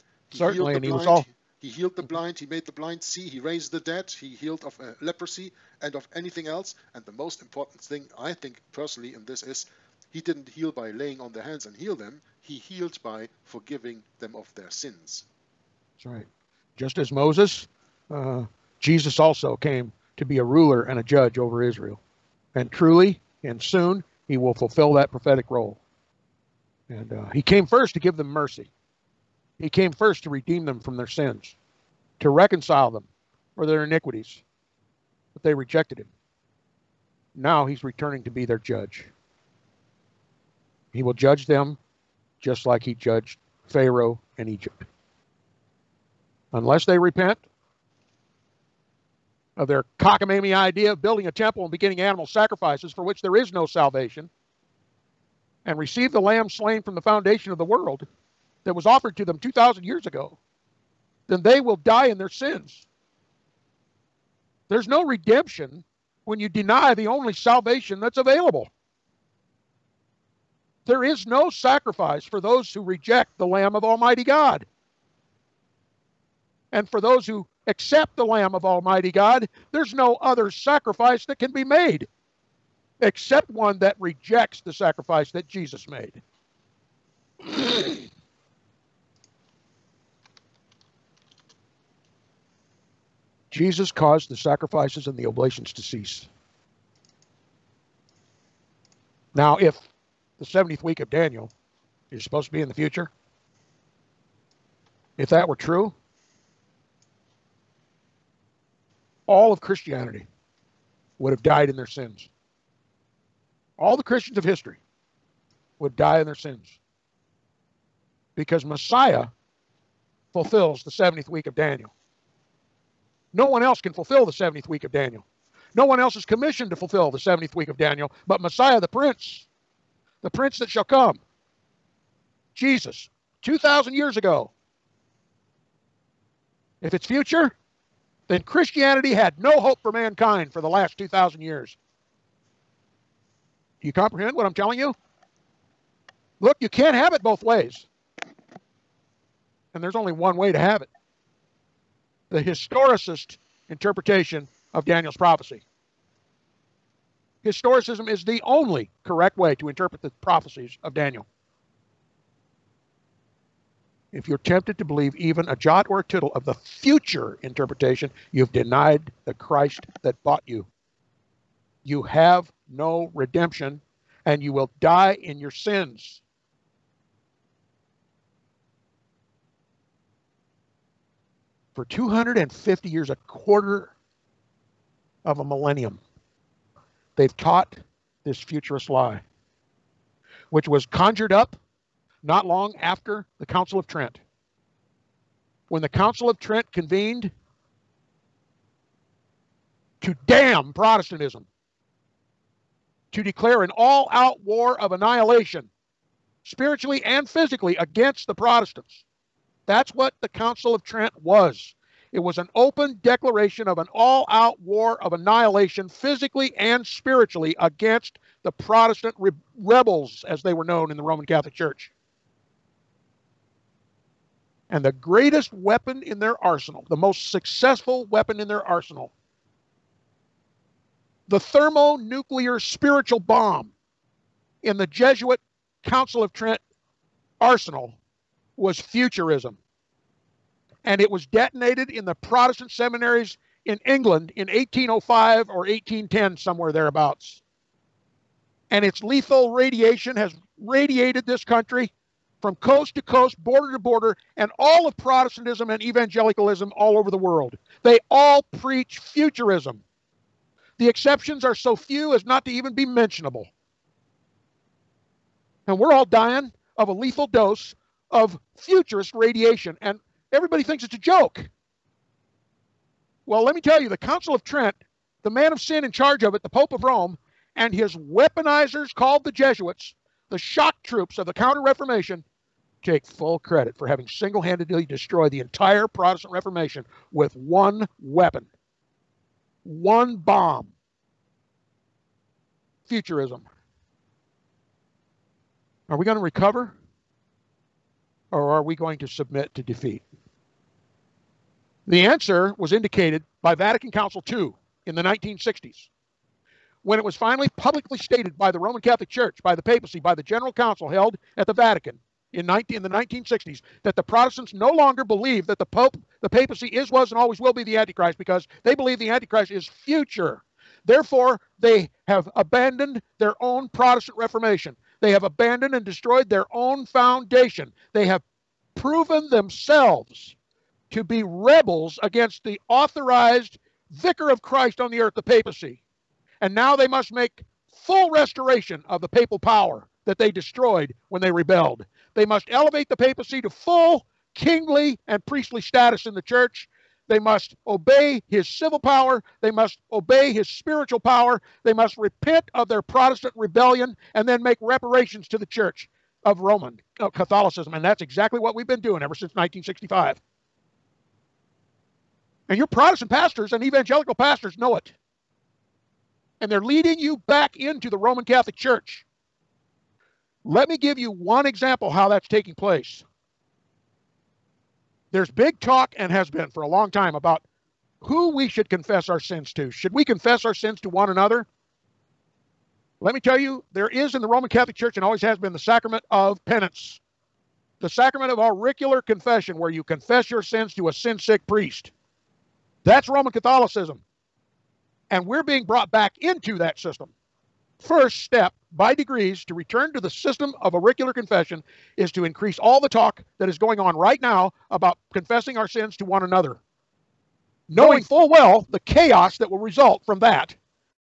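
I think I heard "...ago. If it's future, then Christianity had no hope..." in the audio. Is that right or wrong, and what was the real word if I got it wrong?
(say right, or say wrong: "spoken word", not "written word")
right.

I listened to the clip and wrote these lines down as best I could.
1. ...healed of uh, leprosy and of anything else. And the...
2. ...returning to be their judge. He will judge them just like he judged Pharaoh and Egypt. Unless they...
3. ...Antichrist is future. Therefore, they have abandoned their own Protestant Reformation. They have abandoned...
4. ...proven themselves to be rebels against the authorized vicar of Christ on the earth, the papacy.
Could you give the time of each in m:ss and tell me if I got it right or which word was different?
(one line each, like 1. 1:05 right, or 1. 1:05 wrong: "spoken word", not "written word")
1. 0:04 right
2. 0:37 right
3. 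5:19 right
4. 5:28 right.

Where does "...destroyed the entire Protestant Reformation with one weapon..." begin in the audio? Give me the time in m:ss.
4:44.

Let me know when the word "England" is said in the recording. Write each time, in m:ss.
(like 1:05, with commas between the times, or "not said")
4:03.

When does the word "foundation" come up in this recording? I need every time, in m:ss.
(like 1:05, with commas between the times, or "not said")
0:56, 5:26.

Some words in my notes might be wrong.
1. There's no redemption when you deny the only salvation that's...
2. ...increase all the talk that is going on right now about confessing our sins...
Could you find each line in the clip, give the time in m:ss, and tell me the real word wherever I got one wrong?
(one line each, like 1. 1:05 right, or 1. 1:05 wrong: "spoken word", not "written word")
1. 1:04 right
2. 6:42 right.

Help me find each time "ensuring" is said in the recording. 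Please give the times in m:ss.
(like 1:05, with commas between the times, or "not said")
not said.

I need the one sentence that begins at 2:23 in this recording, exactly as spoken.
Do you comprehend what I'm telling you?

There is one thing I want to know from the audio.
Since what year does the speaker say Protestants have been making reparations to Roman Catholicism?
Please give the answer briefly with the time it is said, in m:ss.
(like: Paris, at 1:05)
1965, at 5:59.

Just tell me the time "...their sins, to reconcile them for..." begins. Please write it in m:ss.
0:30.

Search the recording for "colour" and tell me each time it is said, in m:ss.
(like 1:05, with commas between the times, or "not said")
not said.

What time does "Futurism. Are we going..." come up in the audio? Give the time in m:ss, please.
4:52.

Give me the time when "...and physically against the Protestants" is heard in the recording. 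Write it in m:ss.
3:27.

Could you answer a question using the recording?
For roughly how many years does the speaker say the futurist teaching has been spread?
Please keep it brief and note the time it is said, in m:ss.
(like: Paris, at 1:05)
250 years, at 3:01.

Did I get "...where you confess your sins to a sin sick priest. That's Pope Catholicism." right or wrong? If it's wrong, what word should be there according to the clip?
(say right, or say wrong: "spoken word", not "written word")
wrong: "Roman", not "Pope".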